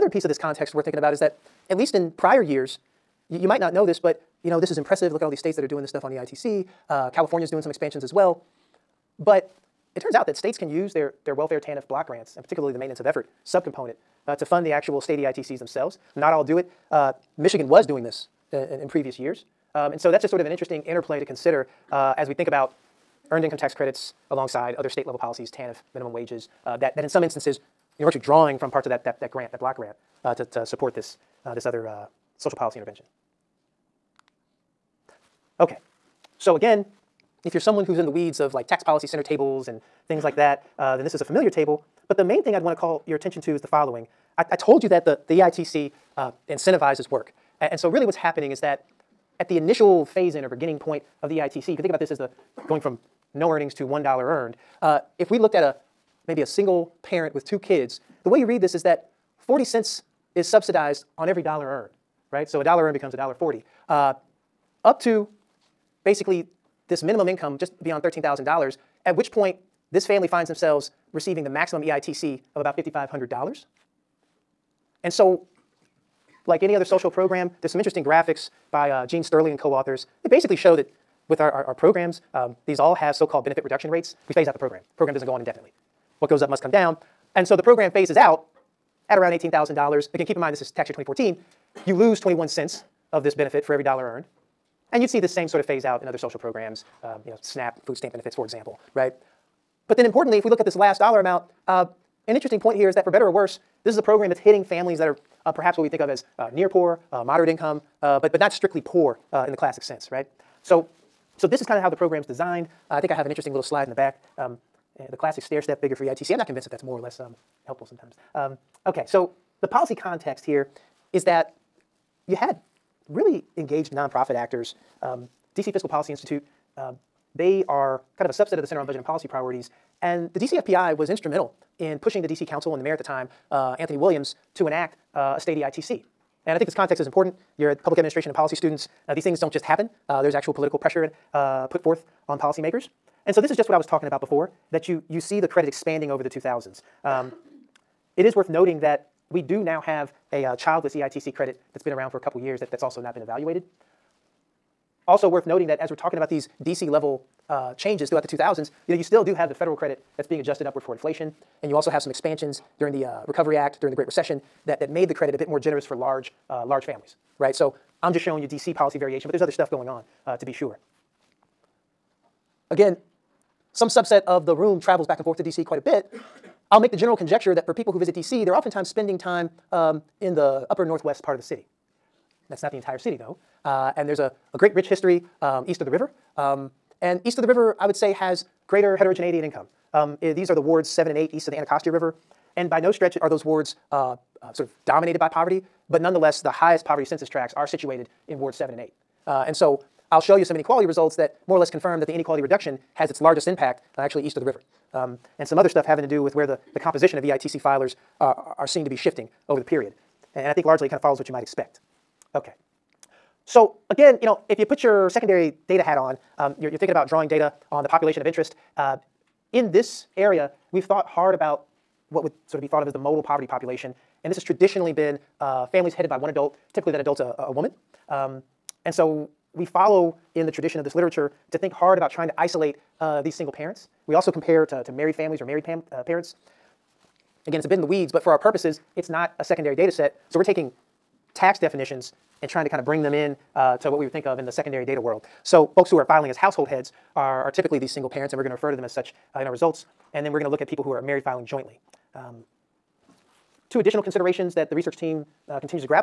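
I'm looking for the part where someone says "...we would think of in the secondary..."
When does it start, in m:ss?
4:03.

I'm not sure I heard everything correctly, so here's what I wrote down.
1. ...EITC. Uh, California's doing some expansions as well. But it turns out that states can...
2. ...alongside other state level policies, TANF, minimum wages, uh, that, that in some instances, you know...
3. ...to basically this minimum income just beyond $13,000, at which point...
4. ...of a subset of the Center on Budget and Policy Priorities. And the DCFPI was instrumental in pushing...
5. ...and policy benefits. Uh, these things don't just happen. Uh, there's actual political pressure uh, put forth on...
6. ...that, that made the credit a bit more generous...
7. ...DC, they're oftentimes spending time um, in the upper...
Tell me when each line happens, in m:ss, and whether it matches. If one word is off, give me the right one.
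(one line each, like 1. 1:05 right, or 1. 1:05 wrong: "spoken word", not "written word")
1. 0:06 right
2. 0:24 right
3. 1:05 right
4. 2:08 right
5. 2:18 wrong: "students", not "benefits"
6. 2:44 right
7. 2:58 right.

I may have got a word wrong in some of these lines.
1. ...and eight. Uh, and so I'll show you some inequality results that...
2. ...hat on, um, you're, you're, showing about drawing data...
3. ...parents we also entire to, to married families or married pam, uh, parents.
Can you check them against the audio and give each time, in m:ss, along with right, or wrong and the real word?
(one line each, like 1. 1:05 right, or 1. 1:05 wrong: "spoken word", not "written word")
1. 3:18 right
2. 3:35 wrong: "thinking", not "showing"
3. 3:53 wrong: "compare", not "entire".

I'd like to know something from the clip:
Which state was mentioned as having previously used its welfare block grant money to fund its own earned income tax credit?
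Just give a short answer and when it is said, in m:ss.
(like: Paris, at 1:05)
Michigan, at 0:17.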